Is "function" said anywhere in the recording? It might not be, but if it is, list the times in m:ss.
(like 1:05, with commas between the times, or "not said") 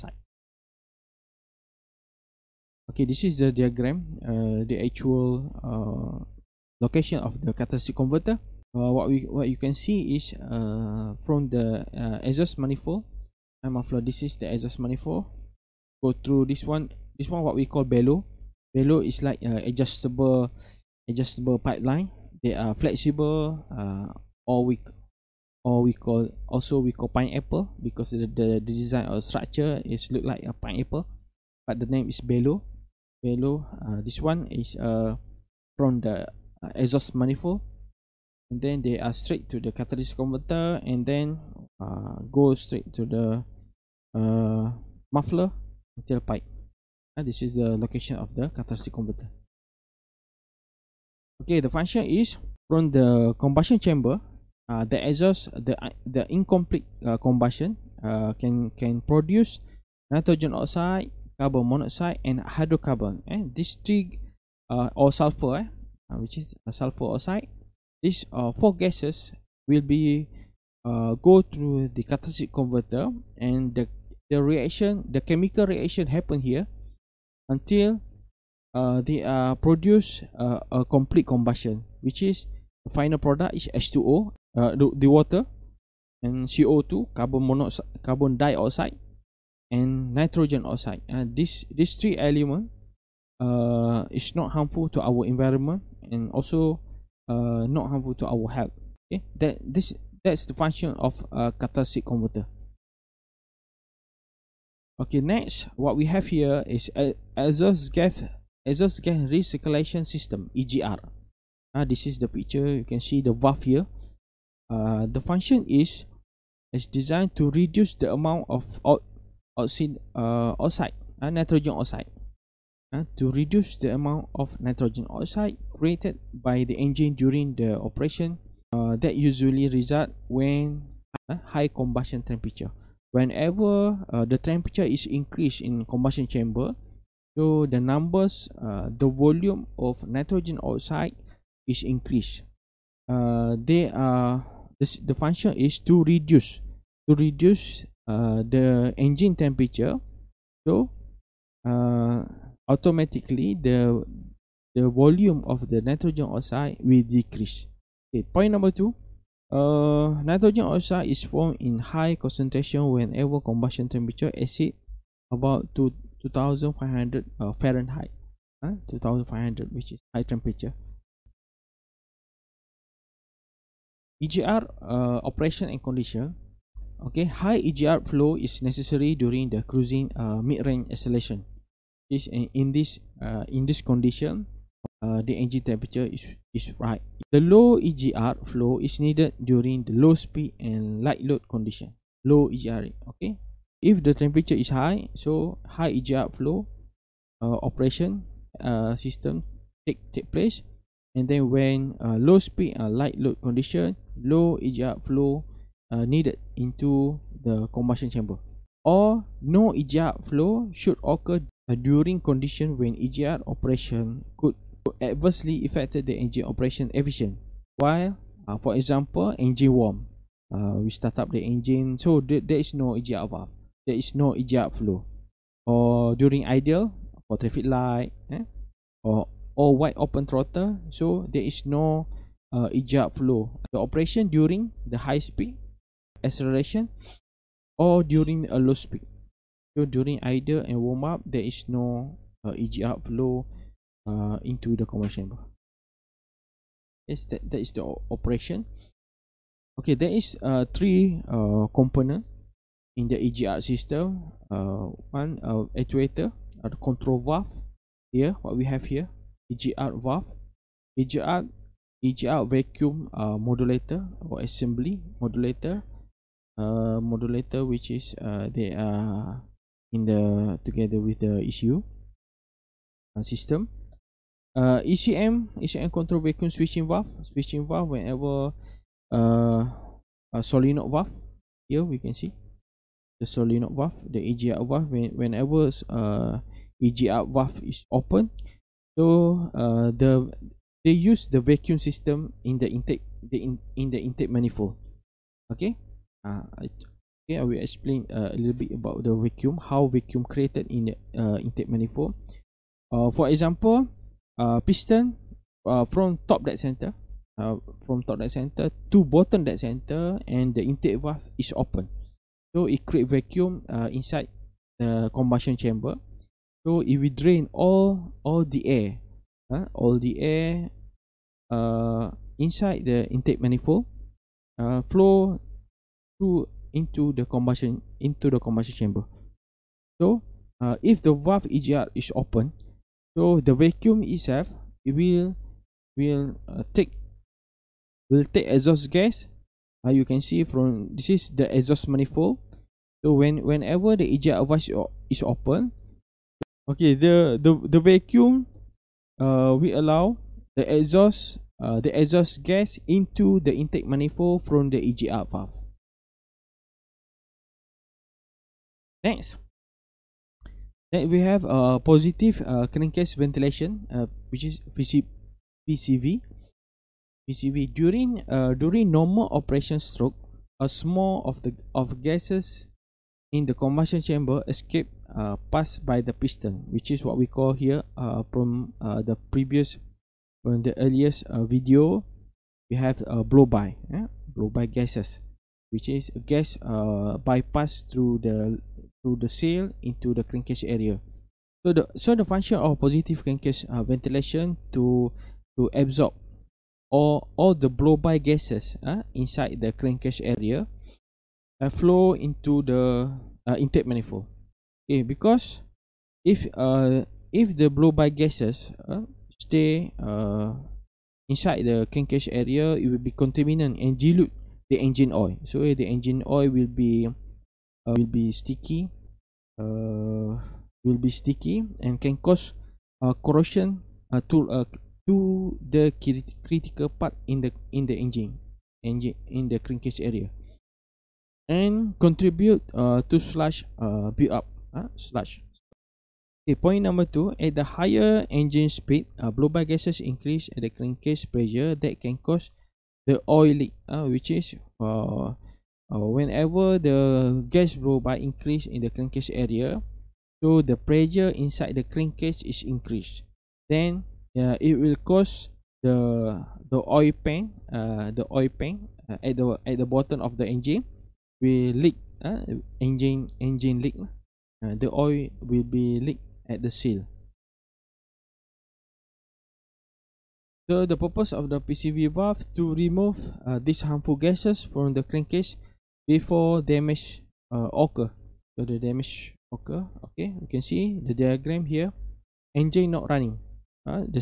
0:51, 1:40, 1:55, 2:25, 6:32.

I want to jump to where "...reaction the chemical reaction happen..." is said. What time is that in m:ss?
1:14.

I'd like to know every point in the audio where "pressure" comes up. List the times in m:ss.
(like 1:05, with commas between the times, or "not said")
7:21, 7:30.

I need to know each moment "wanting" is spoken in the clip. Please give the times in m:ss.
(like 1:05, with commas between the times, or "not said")
not said.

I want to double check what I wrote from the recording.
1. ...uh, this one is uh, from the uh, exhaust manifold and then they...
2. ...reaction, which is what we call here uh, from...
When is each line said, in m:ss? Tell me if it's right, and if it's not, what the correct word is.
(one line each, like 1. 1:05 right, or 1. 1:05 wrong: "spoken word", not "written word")
1. 0:33 right
2. 6:16 wrong: "piston", not "reaction".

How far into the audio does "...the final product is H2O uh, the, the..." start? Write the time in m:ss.
1:22.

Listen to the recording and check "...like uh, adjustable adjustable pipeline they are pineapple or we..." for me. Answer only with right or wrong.
wrong.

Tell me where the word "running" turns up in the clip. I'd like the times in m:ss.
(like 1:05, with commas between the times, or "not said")
8:03.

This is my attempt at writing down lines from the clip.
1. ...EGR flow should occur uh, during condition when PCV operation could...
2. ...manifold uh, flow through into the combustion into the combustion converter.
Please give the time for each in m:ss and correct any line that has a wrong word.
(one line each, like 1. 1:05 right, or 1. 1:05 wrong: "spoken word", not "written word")
1. 3:29 wrong: "EGR", not "PCV"
2. 5:23 wrong: "chamber", not "converter".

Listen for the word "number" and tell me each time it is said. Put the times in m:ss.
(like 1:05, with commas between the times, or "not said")
2:17, 2:38, 7:16.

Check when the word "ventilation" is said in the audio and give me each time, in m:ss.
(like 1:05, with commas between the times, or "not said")
6:03, 6:33.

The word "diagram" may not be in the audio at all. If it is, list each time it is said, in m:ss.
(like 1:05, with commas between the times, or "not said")
0:03, 8:01.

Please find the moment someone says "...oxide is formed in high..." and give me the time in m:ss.
2:40.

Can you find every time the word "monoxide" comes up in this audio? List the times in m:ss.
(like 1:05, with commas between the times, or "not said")
1:01, 1:27.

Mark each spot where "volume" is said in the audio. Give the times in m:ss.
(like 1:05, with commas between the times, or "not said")
2:19, 2:34.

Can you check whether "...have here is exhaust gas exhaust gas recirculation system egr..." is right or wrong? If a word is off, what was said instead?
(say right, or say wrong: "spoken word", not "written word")
right.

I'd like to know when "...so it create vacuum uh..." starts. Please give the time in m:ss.
5:12.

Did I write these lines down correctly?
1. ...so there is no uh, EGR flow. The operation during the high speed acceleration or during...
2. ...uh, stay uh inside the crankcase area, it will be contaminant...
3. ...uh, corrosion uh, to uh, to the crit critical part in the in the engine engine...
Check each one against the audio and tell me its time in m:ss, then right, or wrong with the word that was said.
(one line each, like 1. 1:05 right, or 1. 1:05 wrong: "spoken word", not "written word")
1. 3:50 right
2. 6:48 right
3. 7:03 right.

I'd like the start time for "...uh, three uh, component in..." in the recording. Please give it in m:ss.
4:10.